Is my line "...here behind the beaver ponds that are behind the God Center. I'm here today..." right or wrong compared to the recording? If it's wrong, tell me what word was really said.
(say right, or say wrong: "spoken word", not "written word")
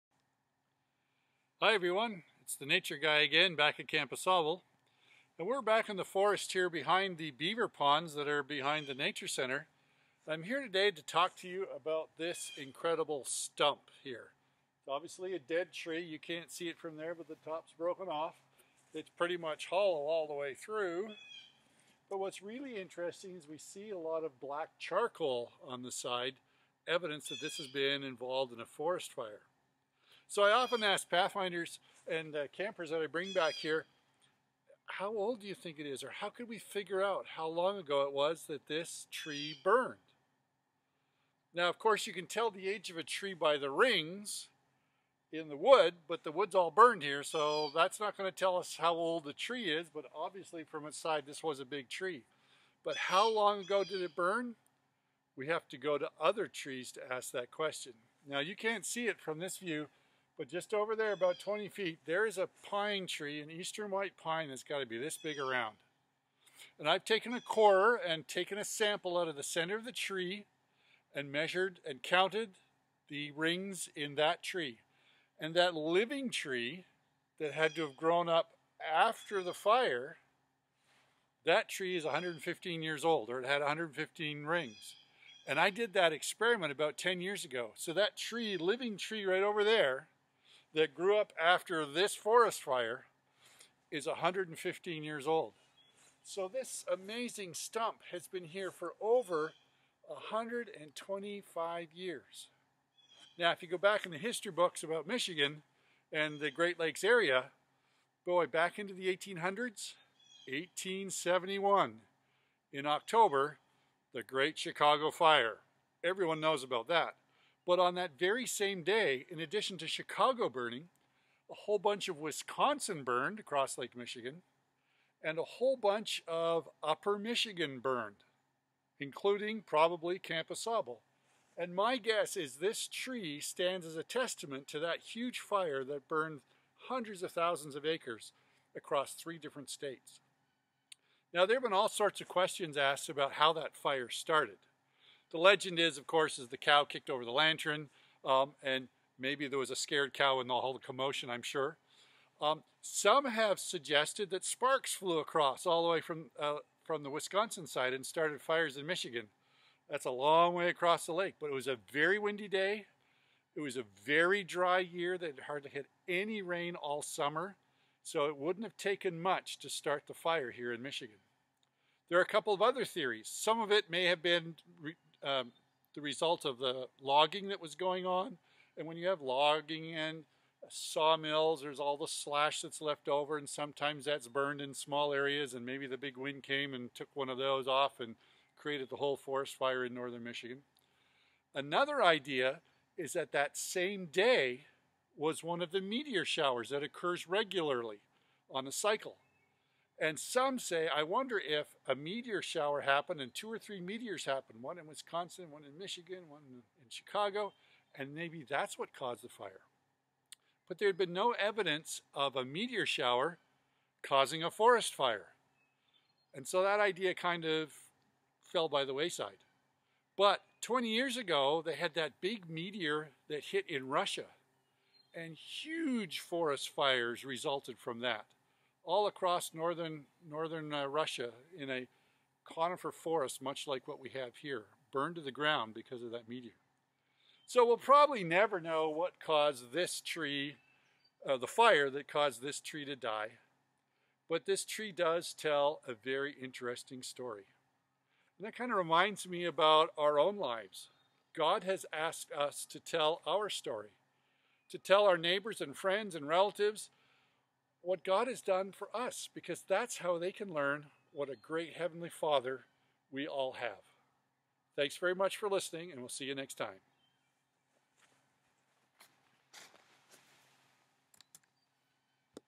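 wrong: "Nature", not "God".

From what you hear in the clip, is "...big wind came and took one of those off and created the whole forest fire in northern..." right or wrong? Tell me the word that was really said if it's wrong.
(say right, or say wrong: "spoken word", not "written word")
right.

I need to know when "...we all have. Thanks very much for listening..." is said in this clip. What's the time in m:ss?
4:23.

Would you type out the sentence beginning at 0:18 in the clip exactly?
It's pretty much hollow all the way through.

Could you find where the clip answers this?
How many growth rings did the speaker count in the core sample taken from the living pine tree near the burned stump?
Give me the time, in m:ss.
1:23.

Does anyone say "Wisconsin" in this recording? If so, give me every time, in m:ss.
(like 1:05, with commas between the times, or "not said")
2:02, 2:37, 3:24.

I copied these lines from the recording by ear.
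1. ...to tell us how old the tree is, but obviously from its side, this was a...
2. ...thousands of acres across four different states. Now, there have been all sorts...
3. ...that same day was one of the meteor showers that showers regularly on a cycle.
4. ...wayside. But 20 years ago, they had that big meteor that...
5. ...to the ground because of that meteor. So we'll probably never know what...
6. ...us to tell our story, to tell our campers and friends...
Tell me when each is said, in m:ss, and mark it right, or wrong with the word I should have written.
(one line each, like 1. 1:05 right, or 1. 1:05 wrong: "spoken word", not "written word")
1. 0:48 right
2. 2:17 wrong: "three", not "four"
3. 3:13 wrong: "occurs", not "showers"
4. 3:38 right
5. 3:55 right
6. 4:12 wrong: "neighbors", not "campers".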